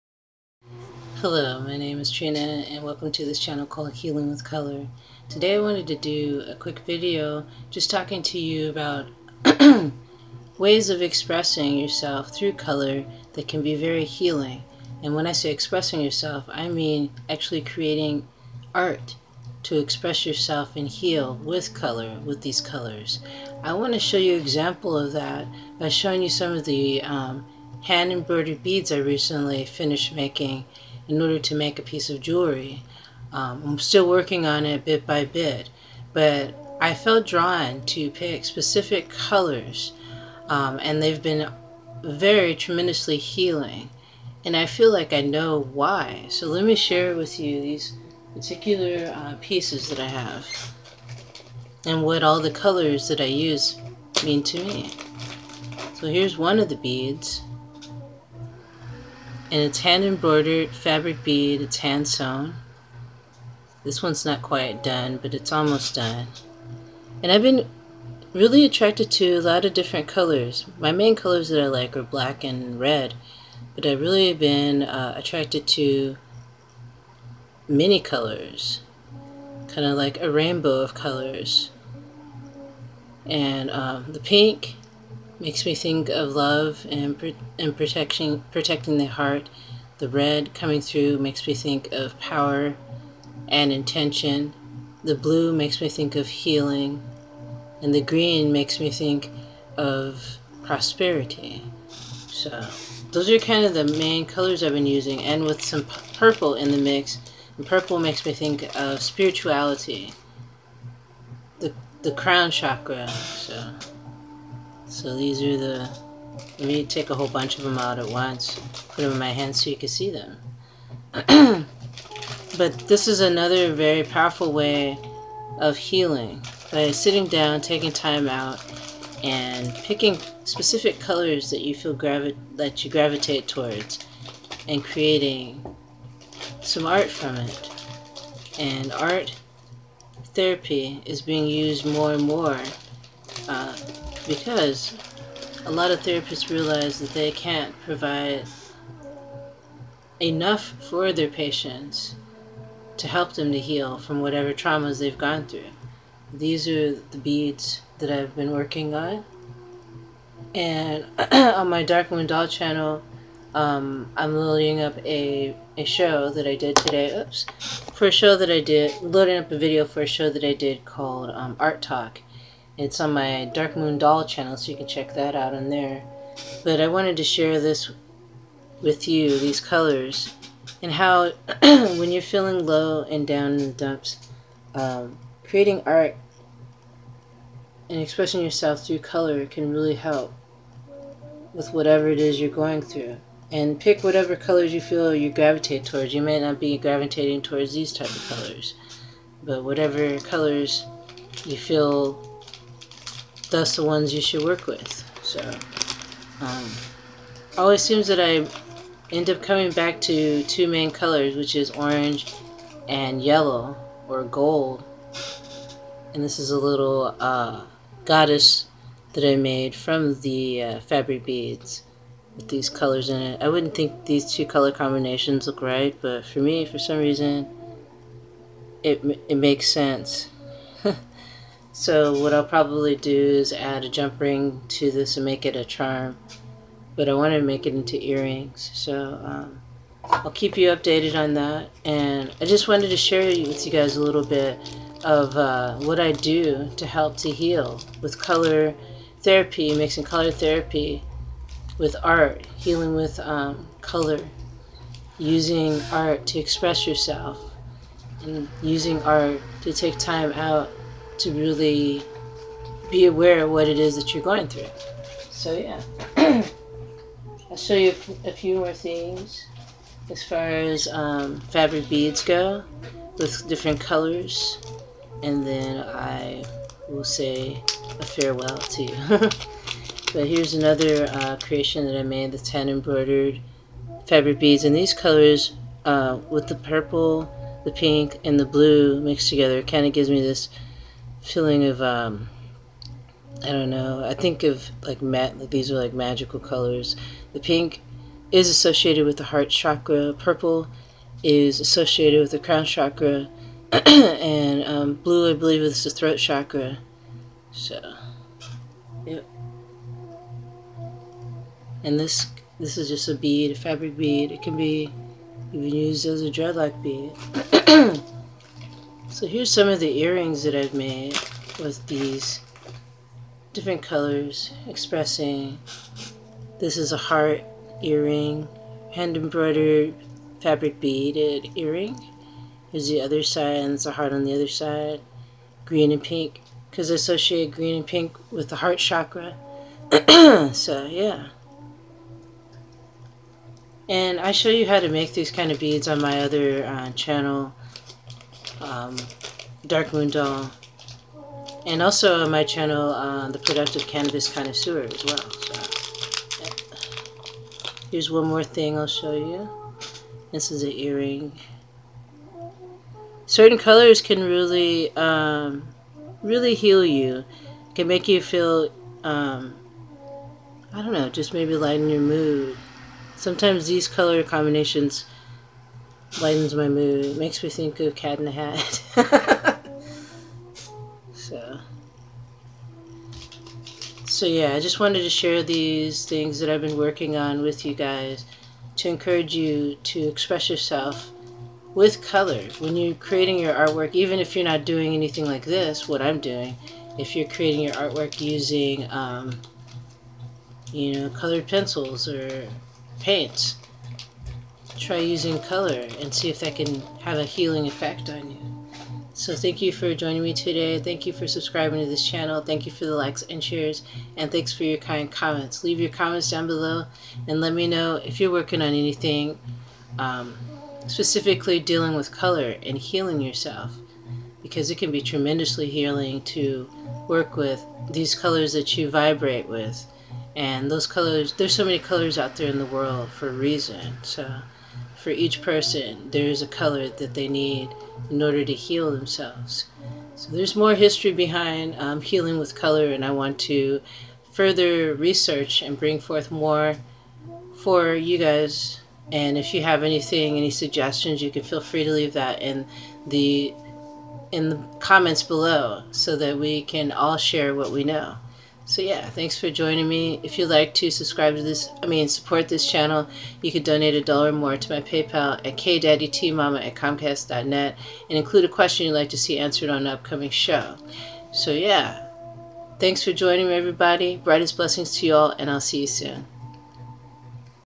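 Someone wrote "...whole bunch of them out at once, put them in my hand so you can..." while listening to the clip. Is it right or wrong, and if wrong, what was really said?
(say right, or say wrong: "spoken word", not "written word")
right.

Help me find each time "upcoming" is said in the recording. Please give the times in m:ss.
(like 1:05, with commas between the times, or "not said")
7:49.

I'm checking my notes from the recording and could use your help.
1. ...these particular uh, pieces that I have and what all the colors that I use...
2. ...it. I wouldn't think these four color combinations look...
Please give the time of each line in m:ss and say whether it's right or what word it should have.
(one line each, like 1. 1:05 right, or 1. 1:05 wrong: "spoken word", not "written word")
1. 0:47 right
2. 3:43 wrong: "two", not "four".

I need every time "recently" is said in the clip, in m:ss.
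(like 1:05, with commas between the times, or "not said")
0:28.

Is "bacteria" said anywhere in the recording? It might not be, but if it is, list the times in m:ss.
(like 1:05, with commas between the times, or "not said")
not said.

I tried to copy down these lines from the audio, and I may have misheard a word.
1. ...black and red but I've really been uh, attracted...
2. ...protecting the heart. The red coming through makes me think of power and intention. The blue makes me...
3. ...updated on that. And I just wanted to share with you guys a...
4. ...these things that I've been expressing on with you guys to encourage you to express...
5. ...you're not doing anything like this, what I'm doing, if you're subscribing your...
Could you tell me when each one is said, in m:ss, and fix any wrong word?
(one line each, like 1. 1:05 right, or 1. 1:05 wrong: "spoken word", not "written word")
1. 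1:12 right
2. 1:28 right
3. 4:00 right
4. 6:25 wrong: "working", not "expressing"
5. 6:34 wrong: "creating", not "subscribing".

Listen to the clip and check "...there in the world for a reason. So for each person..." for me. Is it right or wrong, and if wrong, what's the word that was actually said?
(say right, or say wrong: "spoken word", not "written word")
right.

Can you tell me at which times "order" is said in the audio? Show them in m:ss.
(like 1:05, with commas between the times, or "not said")
0:31, 7:18.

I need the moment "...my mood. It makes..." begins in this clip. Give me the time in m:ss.
6:16.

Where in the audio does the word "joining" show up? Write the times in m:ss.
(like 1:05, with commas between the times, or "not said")
6:49, 7:39, 7:53.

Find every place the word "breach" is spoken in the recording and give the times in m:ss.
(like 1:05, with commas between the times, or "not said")
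not said.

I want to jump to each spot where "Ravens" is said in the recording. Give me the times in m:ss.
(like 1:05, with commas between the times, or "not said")
not said.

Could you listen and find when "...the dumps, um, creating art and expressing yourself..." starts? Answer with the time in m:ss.
3:03.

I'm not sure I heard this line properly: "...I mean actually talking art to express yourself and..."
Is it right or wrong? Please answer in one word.
wrong.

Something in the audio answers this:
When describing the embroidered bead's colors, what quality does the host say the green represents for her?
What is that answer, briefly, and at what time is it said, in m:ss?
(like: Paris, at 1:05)
Prosperity, at 1:40.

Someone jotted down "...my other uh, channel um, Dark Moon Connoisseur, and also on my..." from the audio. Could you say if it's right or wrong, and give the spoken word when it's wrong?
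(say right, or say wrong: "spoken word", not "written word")
wrong: "Doll", not "Connoisseur".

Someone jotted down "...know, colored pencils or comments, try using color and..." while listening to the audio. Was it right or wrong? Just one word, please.
wrong.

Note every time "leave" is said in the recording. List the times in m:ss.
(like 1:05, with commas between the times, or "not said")
6:55, 7:31.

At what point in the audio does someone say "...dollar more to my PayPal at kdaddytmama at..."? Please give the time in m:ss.
7:44.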